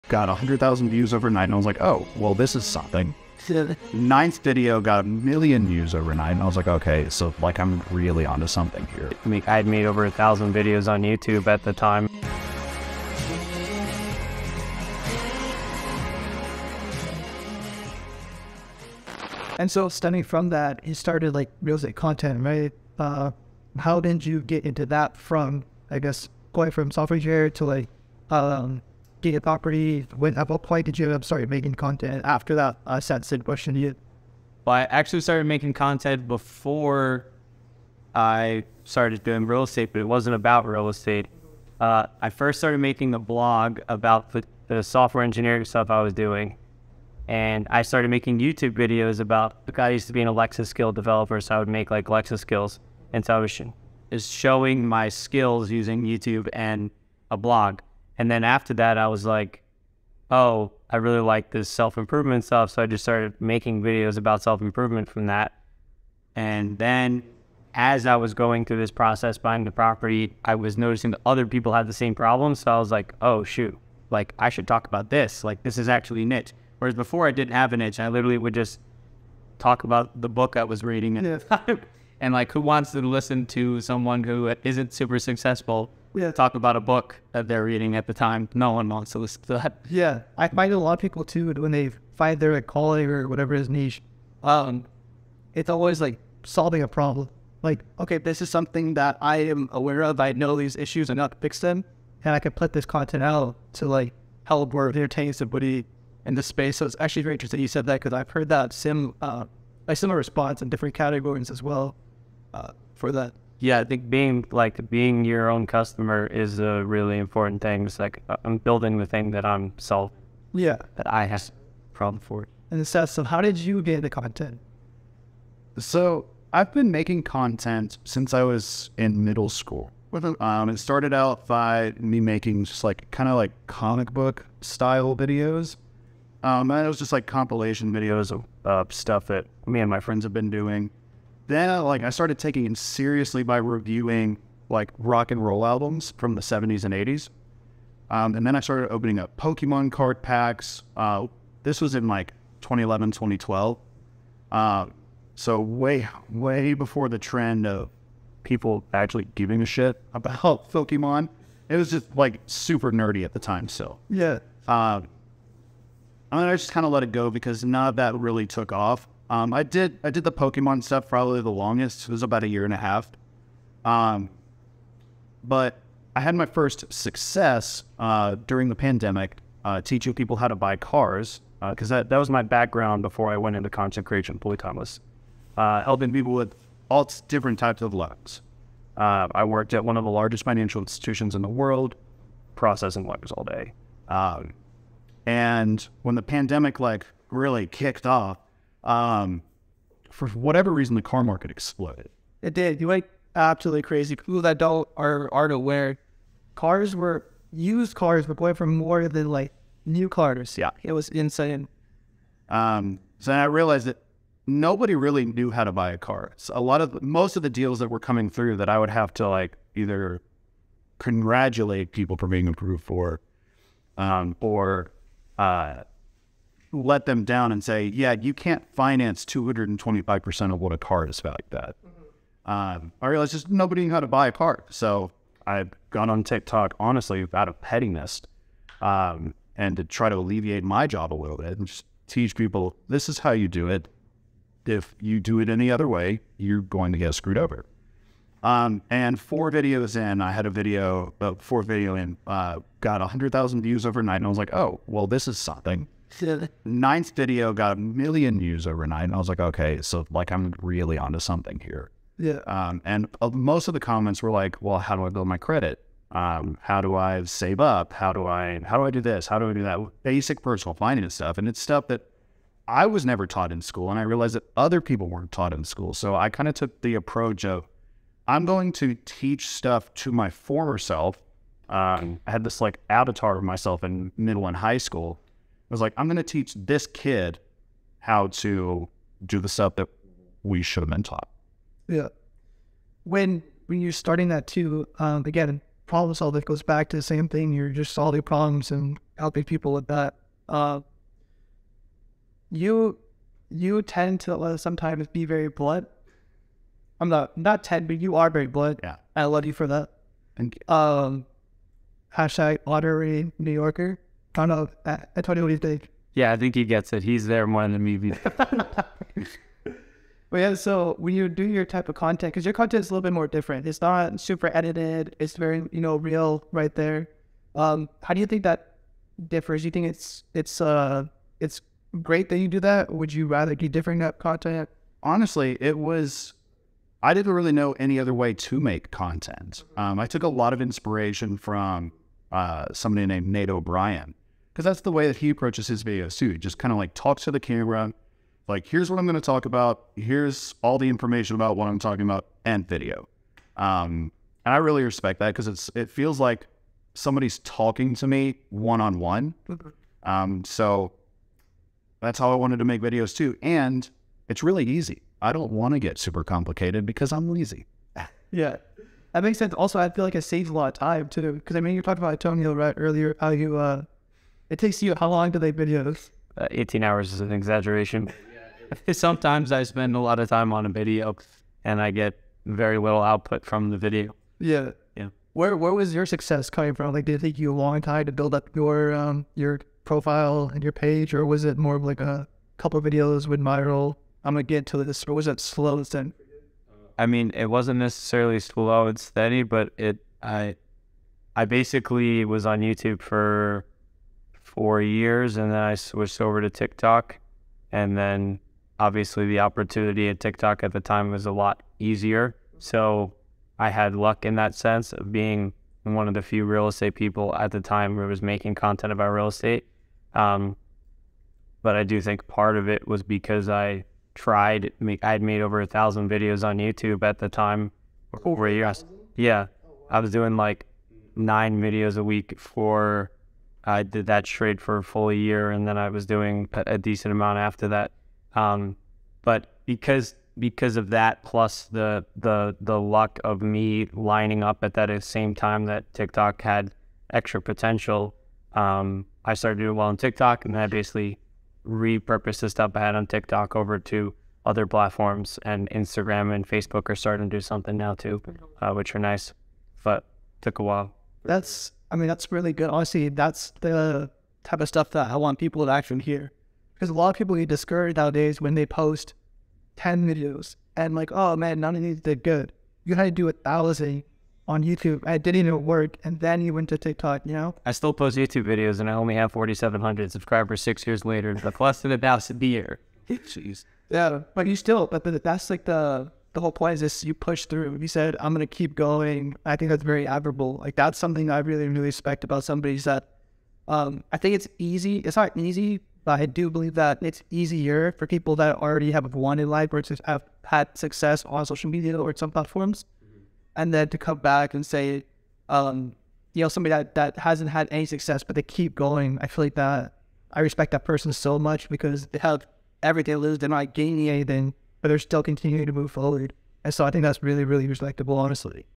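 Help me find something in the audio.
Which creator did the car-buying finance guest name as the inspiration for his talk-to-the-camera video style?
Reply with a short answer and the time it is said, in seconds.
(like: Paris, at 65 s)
Nate O'Brien, at 343 s.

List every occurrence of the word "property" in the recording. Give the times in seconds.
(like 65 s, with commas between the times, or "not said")
29 s, 69 s.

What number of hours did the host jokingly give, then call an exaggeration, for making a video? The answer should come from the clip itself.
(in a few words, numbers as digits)
18 hours.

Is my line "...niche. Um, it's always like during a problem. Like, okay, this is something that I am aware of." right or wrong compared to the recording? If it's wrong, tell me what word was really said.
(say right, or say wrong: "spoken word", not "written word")
wrong: "solving", not "during".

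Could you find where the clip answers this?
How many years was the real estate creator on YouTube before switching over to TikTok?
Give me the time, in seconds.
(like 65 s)
404 s.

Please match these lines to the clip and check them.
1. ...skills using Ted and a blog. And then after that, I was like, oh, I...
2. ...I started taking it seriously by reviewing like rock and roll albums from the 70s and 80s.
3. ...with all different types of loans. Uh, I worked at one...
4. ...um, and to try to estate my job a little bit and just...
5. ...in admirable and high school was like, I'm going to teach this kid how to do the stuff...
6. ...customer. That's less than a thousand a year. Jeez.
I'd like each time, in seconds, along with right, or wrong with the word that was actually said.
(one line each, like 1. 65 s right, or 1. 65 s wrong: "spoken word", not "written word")
1. 55 s wrong: "YouTube", not "Ted"
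2. 142 s right
3. 186 s right
4. 238 s wrong: "alleviate", not "estate"
5. 283 s wrong: "middle", not "admirable"
6. 481 s wrong: "later", not "customer".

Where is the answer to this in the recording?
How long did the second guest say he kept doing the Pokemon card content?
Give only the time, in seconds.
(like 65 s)
172 s.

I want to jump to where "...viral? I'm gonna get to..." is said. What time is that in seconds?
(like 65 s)
393 s.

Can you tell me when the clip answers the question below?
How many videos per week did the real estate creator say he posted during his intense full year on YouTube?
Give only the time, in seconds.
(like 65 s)
431 s.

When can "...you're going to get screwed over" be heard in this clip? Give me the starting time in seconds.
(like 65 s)
246 s.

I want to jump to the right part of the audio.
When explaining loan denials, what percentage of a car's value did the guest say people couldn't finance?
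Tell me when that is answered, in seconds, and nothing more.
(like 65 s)
229 s.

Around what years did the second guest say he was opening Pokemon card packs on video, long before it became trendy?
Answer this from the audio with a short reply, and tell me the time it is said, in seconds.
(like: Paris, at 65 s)
2011, 2012, at 152 s.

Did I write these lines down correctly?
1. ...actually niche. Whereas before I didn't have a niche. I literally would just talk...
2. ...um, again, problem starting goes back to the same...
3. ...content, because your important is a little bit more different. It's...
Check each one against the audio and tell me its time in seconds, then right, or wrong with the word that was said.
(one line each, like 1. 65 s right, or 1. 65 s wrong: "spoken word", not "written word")
1. 75 s right
2. 294 s wrong: "solving", not "starting"
3. 321 s wrong: "content", not "important".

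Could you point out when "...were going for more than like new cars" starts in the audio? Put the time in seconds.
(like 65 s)
208 s.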